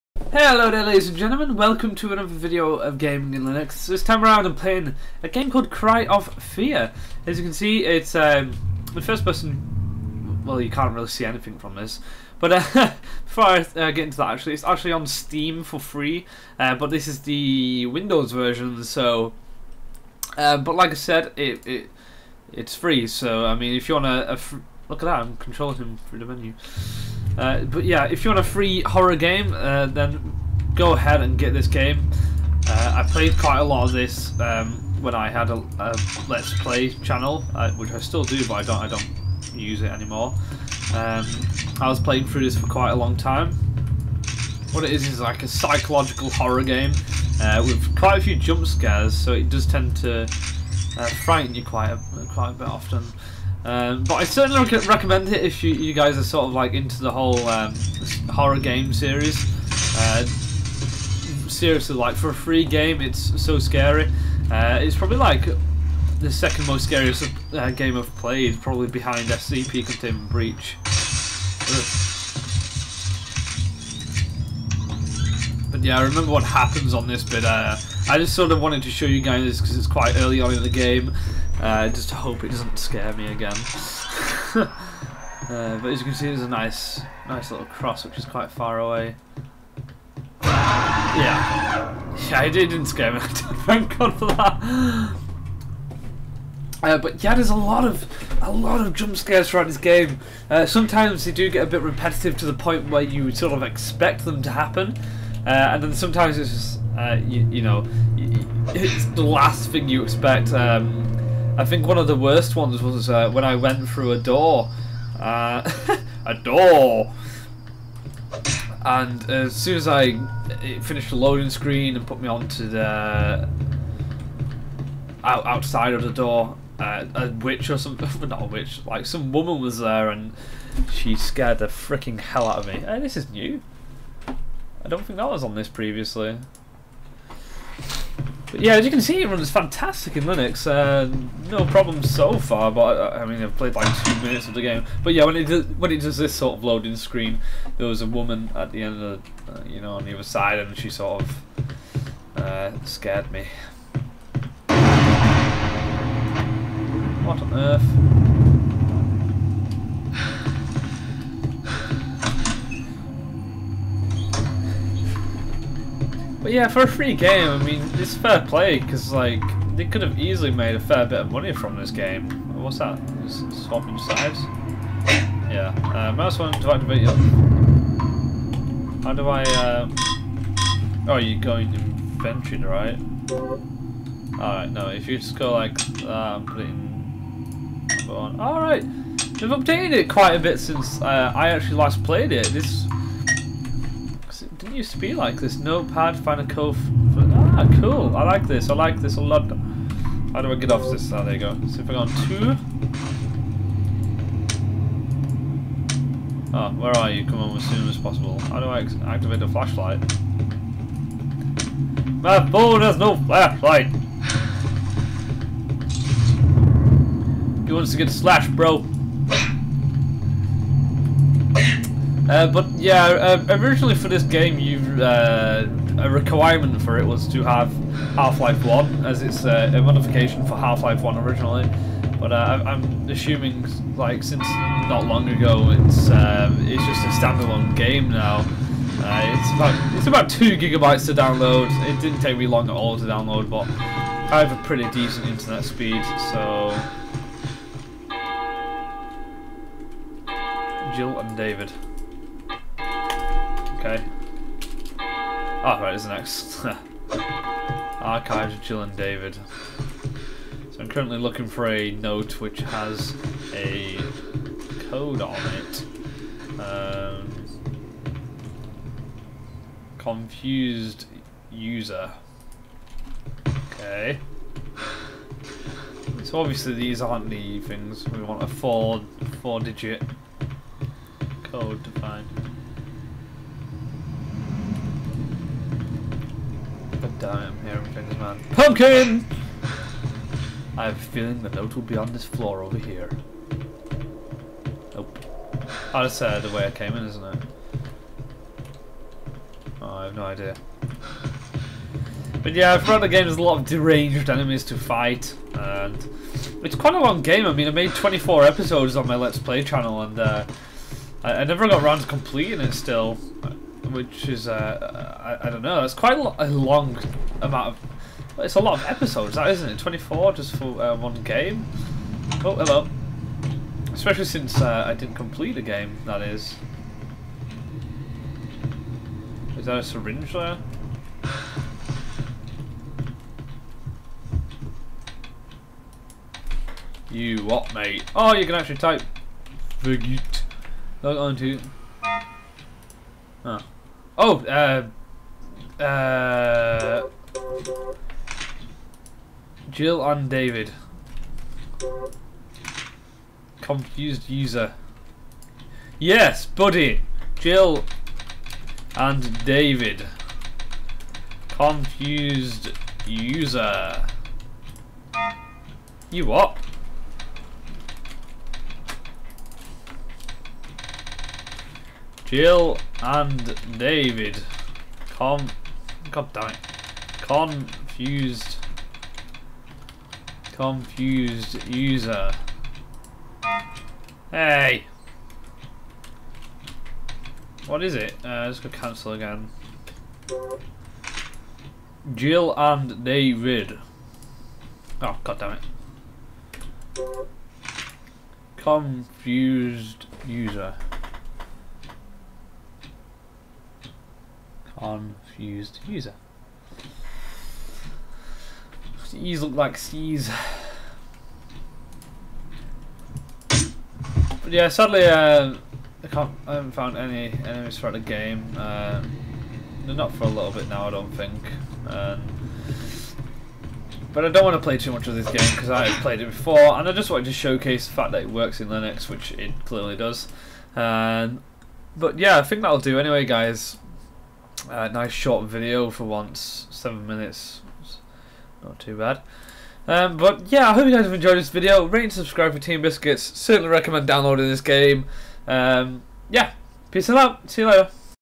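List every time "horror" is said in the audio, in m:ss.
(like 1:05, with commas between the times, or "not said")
0:28, 0:46, 0:58.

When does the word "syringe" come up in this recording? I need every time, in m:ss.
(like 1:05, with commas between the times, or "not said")
5:29.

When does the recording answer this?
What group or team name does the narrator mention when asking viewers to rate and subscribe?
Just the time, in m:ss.
7:22.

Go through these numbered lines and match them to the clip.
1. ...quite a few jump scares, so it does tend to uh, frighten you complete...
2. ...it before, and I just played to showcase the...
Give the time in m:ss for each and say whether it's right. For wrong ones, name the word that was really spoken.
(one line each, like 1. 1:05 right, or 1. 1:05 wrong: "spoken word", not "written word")
1. 0:47 wrong: "quite", not "complete"
2. 7:06 wrong: "wanted", not "played".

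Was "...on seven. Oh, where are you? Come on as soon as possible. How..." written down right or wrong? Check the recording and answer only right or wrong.
wrong.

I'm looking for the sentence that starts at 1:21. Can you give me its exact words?
I uh, just hope it doesn't scare me again.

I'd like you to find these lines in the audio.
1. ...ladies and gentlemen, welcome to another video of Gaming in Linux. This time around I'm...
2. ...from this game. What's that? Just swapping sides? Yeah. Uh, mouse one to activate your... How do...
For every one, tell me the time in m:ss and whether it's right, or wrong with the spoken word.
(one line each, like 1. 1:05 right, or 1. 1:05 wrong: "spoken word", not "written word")
1. 0:00 right
2. 2:51 right.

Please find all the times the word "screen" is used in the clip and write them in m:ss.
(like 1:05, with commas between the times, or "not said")
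2:01, 2:26.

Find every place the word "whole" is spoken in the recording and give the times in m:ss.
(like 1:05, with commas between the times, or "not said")
0:57.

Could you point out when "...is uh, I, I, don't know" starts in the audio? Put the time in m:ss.
5:14.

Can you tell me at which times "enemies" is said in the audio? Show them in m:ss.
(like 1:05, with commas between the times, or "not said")
5:04, 6:57.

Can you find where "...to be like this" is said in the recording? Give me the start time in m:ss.
3:14.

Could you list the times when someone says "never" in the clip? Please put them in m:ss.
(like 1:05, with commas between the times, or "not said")
5:11.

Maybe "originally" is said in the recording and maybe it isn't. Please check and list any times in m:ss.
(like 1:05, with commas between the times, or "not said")
3:43, 3:51.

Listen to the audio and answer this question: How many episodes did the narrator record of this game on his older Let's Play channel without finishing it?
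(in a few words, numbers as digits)
24.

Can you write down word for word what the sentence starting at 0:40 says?
Um, I was playing through this for quite a long time.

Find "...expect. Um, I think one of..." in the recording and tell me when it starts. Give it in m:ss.
1:50.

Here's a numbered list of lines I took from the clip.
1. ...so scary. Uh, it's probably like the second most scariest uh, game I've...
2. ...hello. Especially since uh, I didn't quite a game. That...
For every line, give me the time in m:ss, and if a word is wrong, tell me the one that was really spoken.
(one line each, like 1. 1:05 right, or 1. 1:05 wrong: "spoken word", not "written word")
1. 1:03 right
2. 5:22 wrong: "complete", not "quite".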